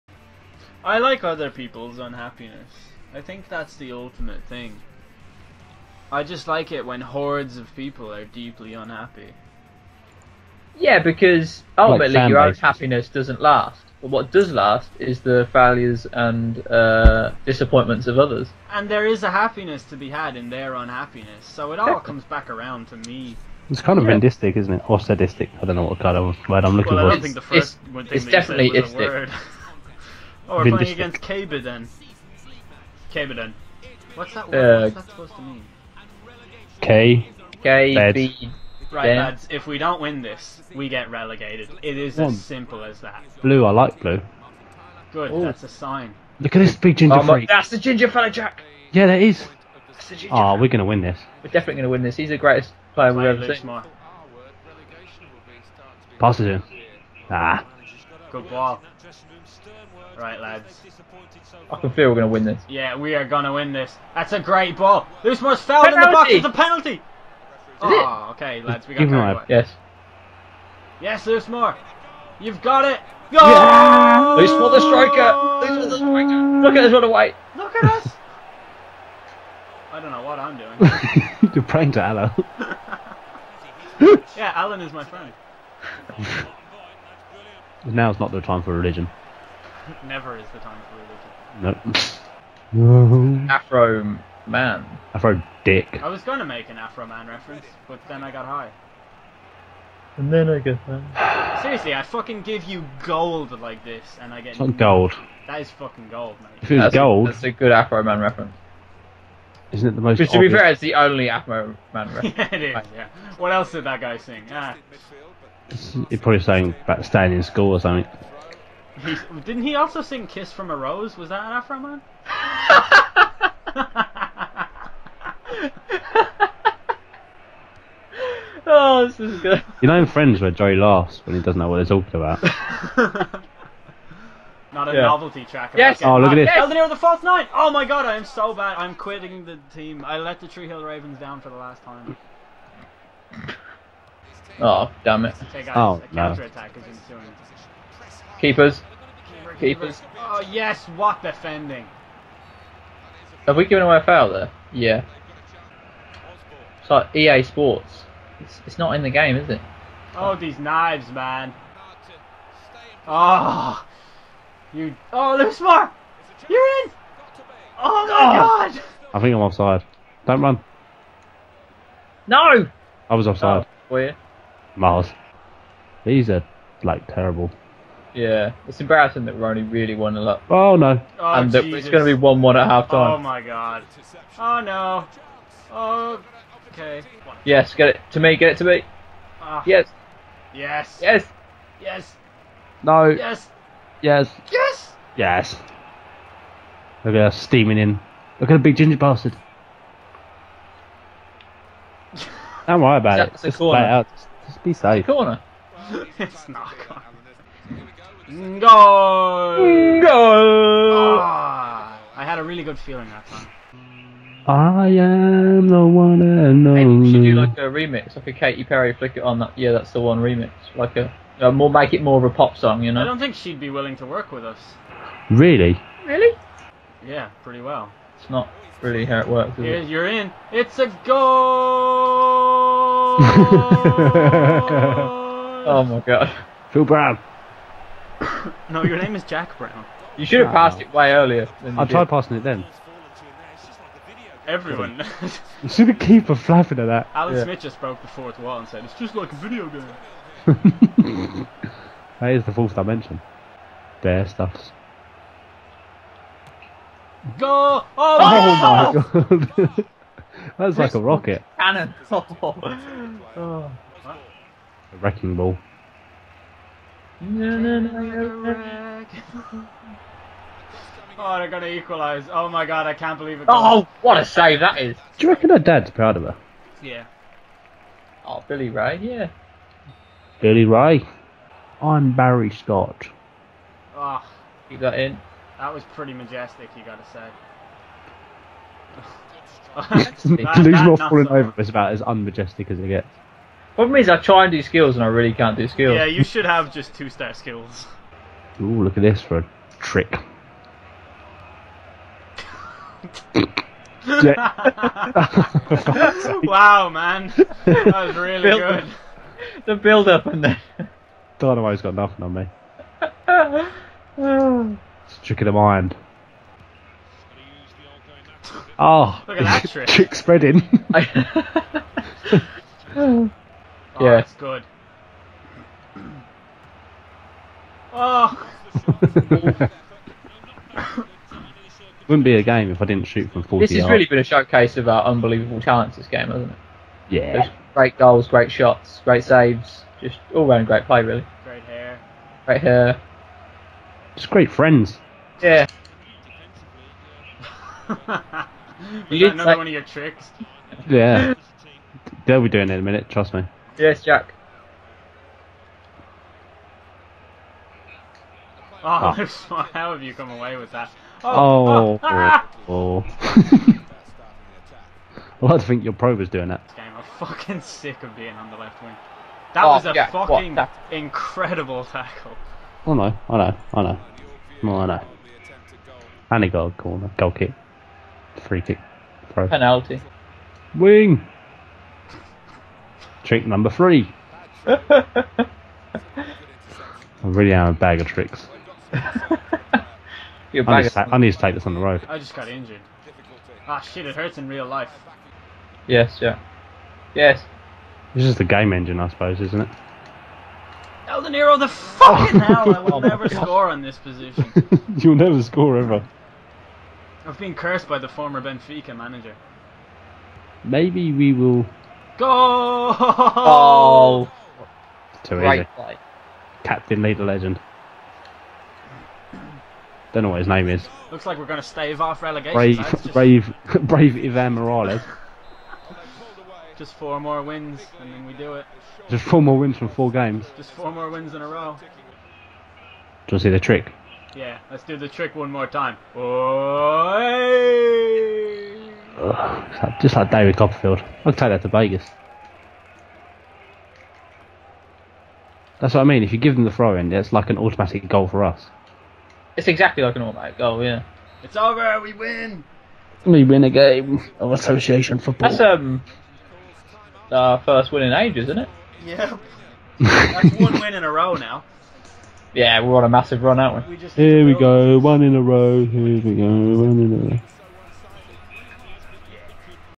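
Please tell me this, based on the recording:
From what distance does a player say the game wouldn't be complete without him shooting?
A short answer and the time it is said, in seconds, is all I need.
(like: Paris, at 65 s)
40 yards, at 333 s.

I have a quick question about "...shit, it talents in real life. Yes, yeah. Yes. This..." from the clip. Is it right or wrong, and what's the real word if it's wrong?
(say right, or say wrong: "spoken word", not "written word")
wrong: "hurts", not "talents".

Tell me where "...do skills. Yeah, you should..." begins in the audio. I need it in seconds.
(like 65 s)
295 s.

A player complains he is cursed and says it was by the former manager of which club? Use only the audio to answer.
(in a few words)
Benfica.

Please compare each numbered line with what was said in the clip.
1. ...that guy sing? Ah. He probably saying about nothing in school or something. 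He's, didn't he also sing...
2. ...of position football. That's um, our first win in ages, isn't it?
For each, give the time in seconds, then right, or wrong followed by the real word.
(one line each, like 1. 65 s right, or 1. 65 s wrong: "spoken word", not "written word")
1. 113 s wrong: "staying", not "nothing"
2. 454 s wrong: "association", not "position".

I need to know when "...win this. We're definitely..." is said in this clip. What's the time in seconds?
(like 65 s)
50 s.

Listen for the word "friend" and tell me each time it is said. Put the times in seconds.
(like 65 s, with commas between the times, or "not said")
85 s, 130 s, 344 s.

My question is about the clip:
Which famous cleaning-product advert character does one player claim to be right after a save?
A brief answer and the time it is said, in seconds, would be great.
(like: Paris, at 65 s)
Barry Scott, at 282 s.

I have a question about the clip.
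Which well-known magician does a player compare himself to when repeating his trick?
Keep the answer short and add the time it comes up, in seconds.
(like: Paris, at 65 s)
David Copperfield, at 440 s.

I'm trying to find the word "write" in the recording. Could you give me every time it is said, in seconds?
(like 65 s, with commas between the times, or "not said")
not said.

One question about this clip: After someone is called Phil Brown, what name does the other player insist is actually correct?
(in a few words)
Jack Browne.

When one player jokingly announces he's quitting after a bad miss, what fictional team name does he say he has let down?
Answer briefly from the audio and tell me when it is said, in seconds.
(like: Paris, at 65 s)
Tree Hill Ravens, at 140 s.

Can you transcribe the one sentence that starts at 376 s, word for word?
And a goal corner, goal kick free kick throw.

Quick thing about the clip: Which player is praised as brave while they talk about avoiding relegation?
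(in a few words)
Ivan Morales.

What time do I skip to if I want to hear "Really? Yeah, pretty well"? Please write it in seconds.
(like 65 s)
226 s.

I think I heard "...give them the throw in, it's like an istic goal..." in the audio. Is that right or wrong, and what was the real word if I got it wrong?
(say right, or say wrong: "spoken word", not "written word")
wrong: "automatic", not "istic".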